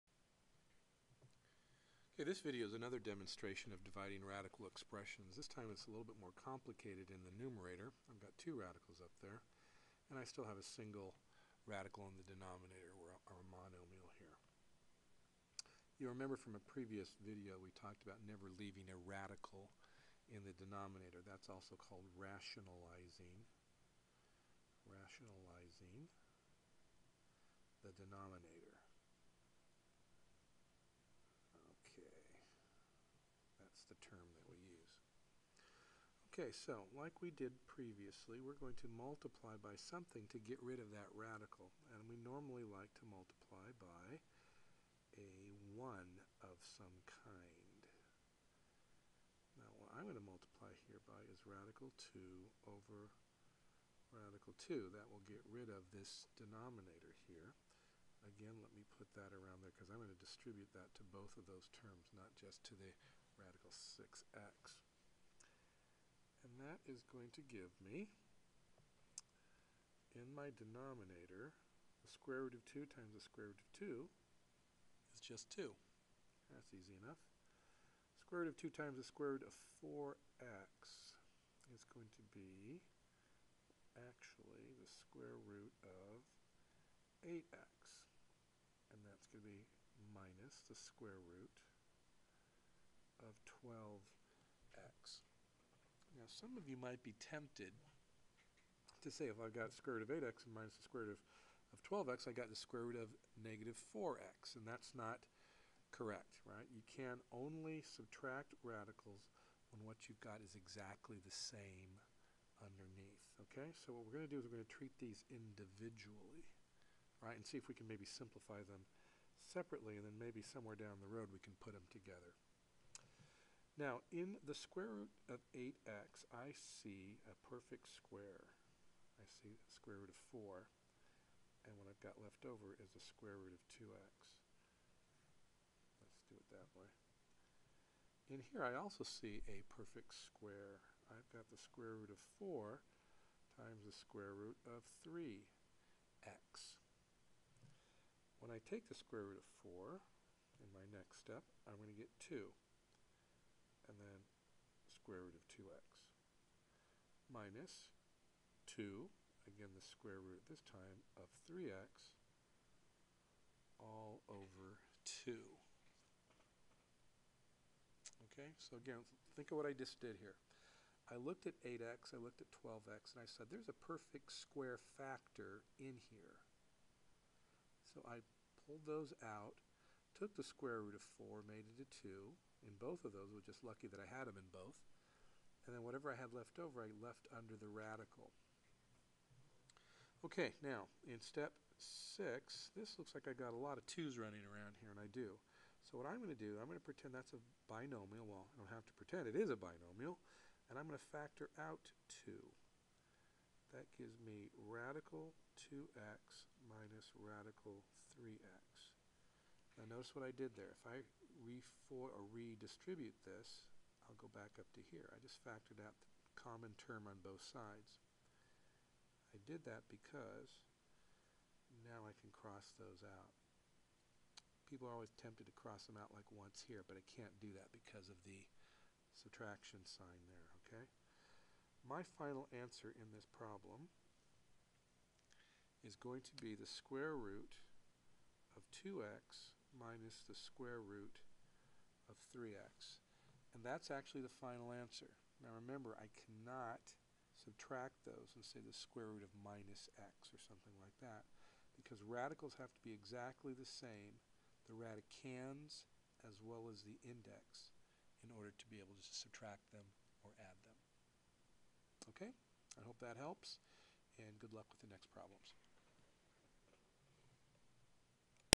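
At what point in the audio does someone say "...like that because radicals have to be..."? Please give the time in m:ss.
4:10.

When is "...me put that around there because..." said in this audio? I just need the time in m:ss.
0:58.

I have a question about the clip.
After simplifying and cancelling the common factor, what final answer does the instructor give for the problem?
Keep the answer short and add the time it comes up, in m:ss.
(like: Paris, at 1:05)
√(2x) − √(3x), at 3:56.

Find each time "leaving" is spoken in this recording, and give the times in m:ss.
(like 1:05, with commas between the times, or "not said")
0:18.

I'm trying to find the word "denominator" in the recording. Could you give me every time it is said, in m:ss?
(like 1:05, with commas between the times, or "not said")
0:12, 0:20, 0:27, 0:56, 1:10.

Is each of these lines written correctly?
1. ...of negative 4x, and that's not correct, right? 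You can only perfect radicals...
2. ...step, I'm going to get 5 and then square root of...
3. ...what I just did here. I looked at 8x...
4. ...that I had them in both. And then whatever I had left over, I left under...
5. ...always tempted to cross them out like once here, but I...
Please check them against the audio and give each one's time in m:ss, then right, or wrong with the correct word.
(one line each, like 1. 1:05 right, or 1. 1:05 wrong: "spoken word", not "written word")
1. 1:42 wrong: "subtract", not "perfect"
2. 2:31 wrong: "2", not "5"
3. 2:49 right
4. 3:03 right
5. 3:44 right.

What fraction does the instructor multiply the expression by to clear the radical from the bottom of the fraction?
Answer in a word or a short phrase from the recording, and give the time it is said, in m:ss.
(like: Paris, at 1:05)
radical 2 over radical 2, at 0:51.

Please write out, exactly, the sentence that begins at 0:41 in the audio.
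And we normally like to multiply by a 1 of some kind.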